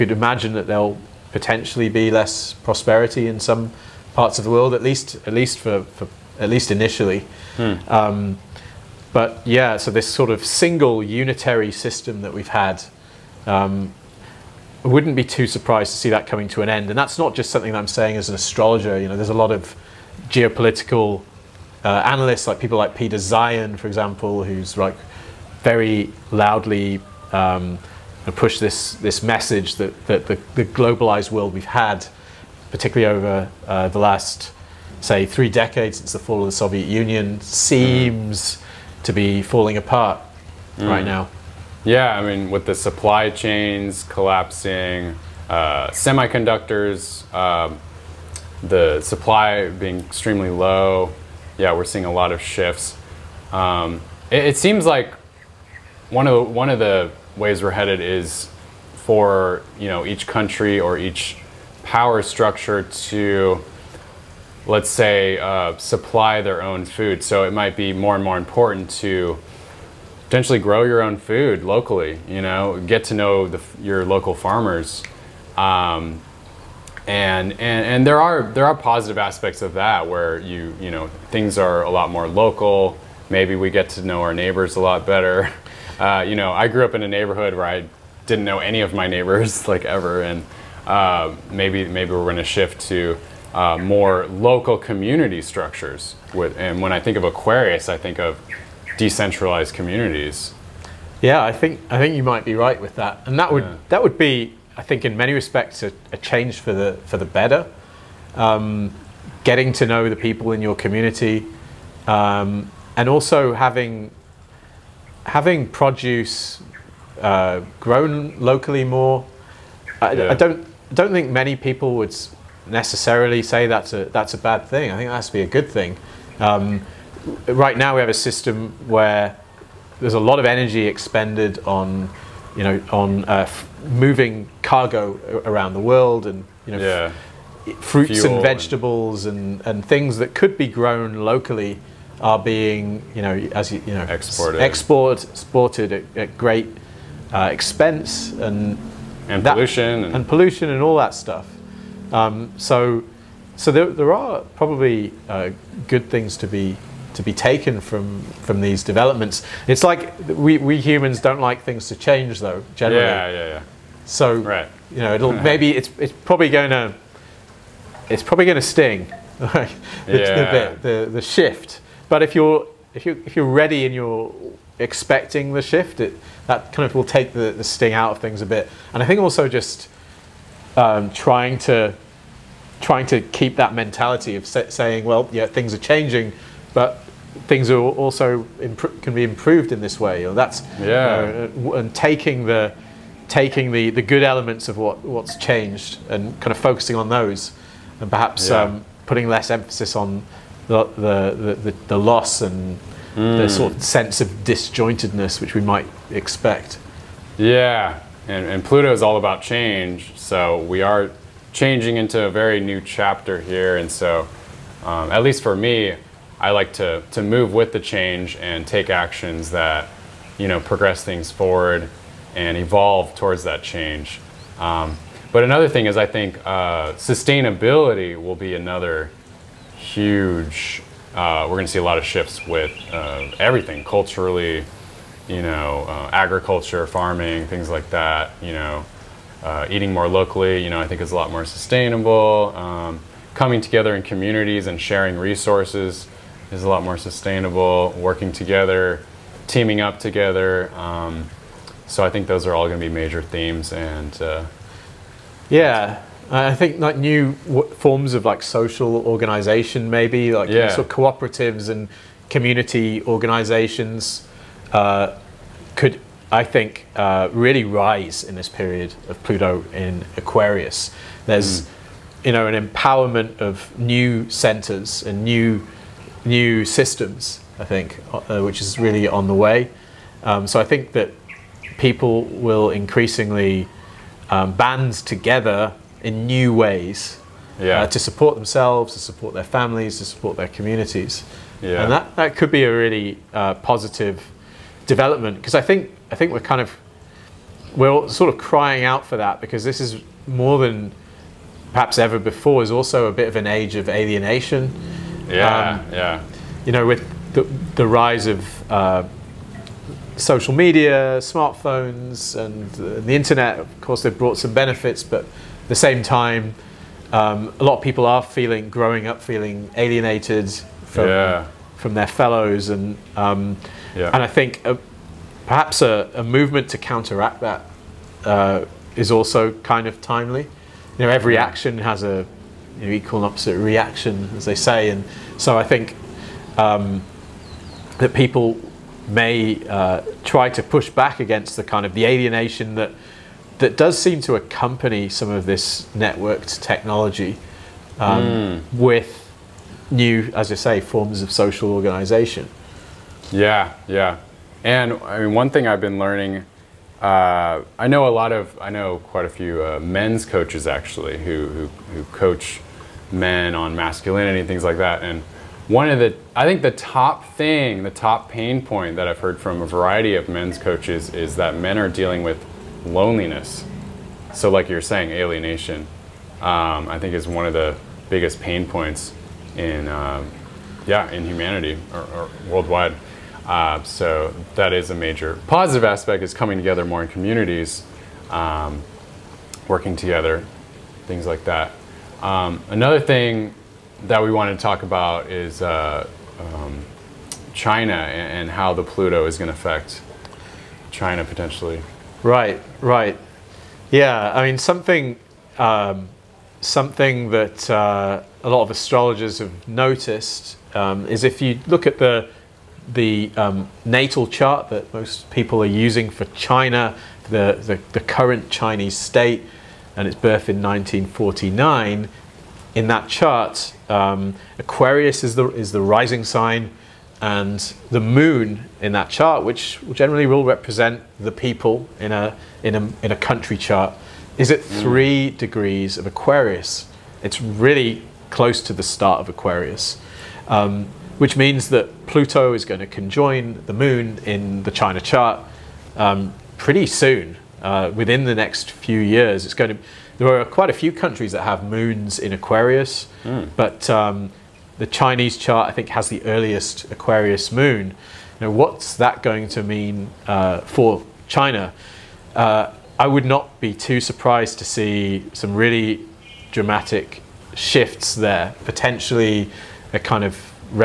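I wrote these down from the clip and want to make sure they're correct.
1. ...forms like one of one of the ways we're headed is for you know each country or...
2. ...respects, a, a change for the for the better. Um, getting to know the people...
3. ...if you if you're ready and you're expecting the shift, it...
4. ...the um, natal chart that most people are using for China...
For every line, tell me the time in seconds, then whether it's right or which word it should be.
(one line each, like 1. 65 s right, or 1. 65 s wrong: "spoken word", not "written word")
1. 54 s wrong: "seems", not "forms"
2. 105 s right
3. 172 s right
4. 412 s right.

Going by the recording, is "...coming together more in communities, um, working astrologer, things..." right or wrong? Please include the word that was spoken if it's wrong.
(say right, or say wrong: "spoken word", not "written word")
wrong: "together", not "astrologer".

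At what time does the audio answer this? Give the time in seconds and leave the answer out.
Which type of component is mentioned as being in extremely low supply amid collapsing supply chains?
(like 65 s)
45 s.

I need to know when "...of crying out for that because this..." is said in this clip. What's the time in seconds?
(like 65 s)
298 s.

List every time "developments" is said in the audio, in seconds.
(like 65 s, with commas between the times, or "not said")
158 s, 294 s.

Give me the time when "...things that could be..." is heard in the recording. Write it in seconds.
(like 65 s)
139 s.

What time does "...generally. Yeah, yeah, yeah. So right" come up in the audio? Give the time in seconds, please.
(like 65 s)
162 s.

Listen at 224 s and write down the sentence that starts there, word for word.
Um, but another thing is, I think uh, sustainability will be another huge.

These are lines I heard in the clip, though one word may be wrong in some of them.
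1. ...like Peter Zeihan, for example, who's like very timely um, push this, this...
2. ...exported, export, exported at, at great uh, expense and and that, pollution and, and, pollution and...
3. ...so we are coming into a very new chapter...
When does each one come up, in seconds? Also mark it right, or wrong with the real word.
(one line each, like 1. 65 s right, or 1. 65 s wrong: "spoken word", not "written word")
1. 22 s wrong: "loudly", not "timely"
2. 144 s right
3. 210 s wrong: "changing", not "coming".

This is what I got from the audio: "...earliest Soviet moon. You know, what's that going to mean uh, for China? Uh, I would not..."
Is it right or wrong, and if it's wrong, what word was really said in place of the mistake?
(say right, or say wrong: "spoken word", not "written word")
wrong: "Aquarius", not "Soviet".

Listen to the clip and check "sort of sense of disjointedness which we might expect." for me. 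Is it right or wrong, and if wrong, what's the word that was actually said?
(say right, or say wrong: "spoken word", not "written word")
right.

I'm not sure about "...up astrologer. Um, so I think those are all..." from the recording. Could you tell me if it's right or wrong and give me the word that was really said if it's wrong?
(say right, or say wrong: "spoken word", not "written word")
wrong: "together", not "astrologer".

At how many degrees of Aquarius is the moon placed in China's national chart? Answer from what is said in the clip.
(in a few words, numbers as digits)
3.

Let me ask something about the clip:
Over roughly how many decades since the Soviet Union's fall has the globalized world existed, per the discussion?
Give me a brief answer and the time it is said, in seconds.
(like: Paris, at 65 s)
3, at 35 s.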